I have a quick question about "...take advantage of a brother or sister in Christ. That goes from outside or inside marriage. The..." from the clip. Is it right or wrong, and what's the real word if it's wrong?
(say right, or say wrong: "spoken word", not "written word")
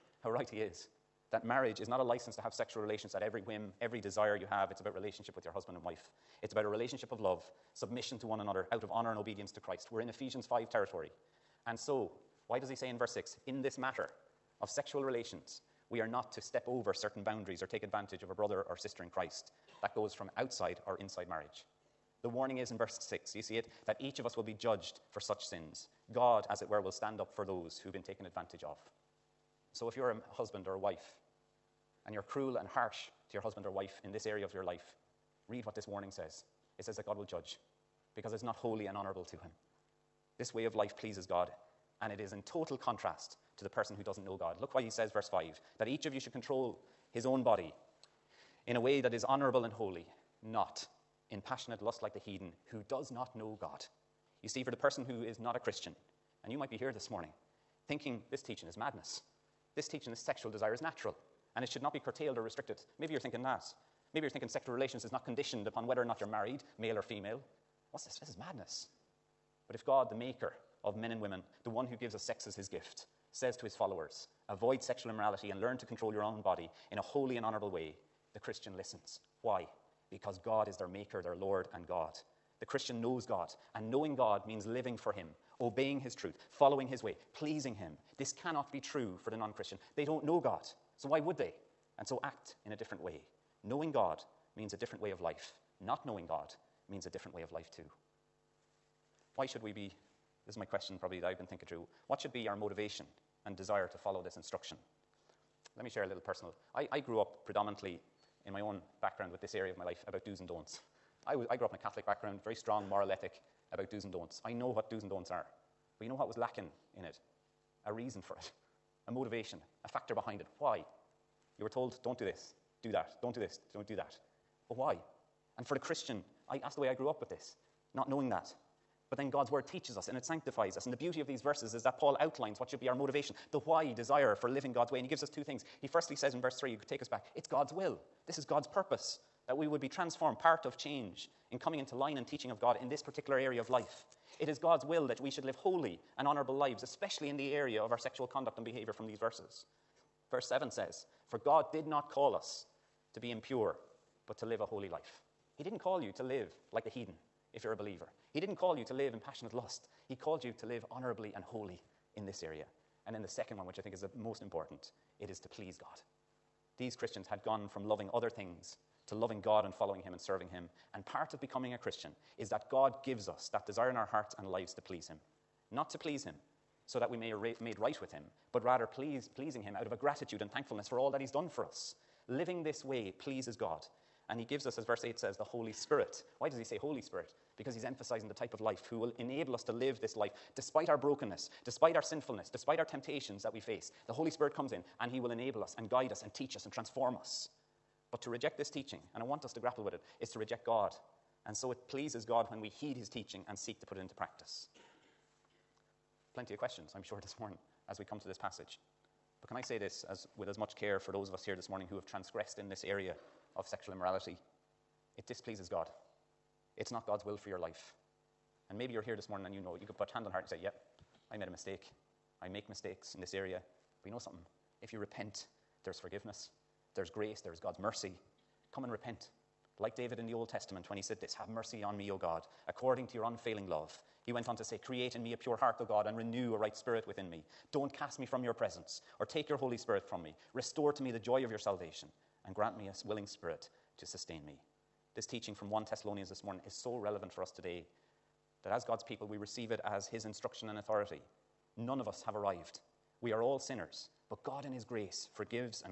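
right.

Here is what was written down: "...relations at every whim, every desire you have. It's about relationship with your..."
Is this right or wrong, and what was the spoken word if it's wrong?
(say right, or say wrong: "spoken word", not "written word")
right.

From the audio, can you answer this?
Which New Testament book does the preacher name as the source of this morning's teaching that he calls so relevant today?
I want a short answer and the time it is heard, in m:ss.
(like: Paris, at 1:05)
1 Thessalonians, at 4:05.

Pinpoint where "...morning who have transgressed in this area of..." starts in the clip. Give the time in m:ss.
3:31.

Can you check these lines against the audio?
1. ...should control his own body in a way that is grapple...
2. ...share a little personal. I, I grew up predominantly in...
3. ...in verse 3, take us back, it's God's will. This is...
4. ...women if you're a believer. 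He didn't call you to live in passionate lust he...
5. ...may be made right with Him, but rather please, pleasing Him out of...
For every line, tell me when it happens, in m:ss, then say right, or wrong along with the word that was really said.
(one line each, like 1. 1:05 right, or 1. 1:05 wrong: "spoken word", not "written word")
1. 0:46 wrong: "honorable", not "grapple"
2. 1:45 right
3. 2:16 right
4. 2:36 wrong: "heathen", not "women"
5. 2:57 right.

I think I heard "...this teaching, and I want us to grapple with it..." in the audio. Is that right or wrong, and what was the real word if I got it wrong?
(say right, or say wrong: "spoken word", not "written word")
right.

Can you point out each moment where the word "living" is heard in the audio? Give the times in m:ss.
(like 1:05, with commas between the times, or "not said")
1:24, 2:14, 3:02.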